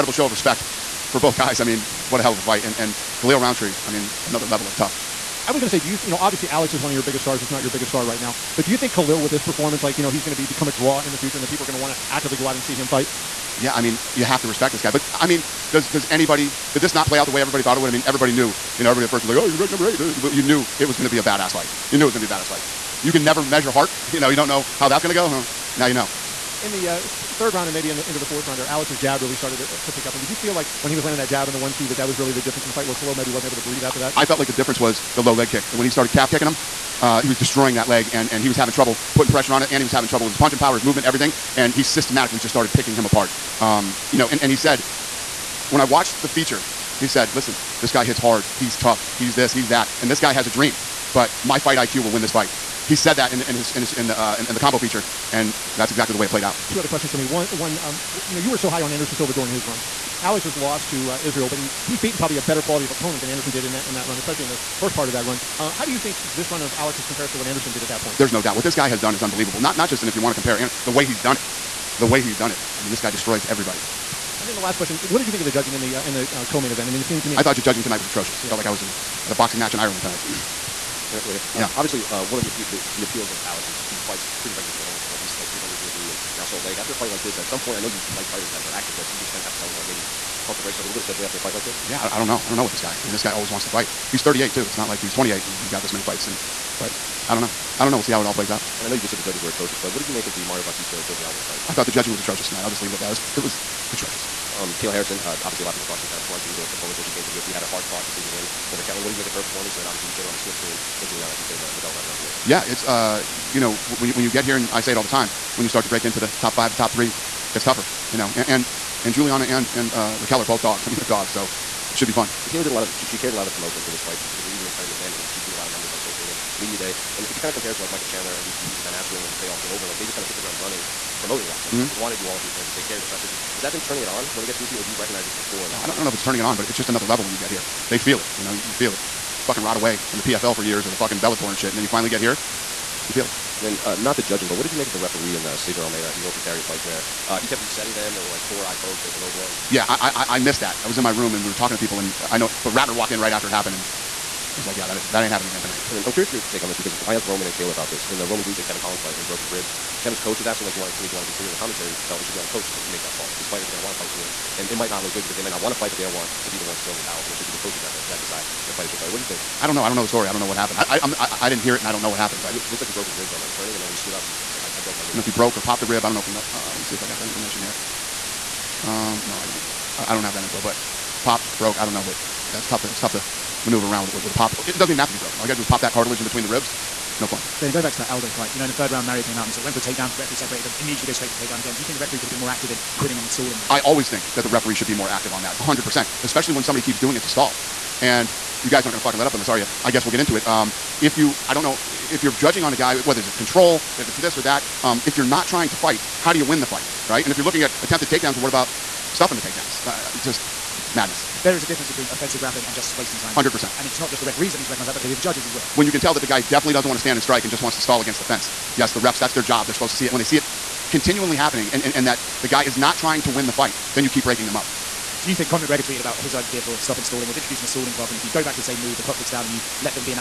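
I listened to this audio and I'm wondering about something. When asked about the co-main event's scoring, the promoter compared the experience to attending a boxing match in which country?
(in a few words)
Ireland.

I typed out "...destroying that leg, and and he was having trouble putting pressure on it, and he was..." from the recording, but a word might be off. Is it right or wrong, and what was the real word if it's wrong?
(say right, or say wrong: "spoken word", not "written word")
right.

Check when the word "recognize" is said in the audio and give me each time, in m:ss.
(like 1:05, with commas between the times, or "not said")
2:14, 3:34.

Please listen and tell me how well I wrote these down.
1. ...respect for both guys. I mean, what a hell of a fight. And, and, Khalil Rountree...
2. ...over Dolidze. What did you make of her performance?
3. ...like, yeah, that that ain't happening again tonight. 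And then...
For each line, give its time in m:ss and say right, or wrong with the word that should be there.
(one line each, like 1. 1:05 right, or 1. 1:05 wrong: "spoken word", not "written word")
1. 0:00 right
2. 1:48 wrong: "Ketlen", not "Dolidze"
3. 2:34 right.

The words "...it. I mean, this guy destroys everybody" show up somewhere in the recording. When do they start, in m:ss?
1:12.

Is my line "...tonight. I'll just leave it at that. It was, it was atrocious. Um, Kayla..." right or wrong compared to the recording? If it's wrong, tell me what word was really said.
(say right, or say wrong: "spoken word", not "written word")
right.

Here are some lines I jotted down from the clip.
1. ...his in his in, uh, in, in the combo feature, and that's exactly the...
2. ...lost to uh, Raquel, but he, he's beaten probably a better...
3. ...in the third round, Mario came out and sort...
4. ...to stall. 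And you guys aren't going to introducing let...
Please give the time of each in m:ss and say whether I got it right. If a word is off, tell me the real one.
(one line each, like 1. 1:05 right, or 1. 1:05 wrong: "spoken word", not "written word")
1. 0:53 right
2. 1:00 wrong: "Israel", not "Raquel"
3. 3:08 right
4. 3:17 wrong: "fucking", not "introducing".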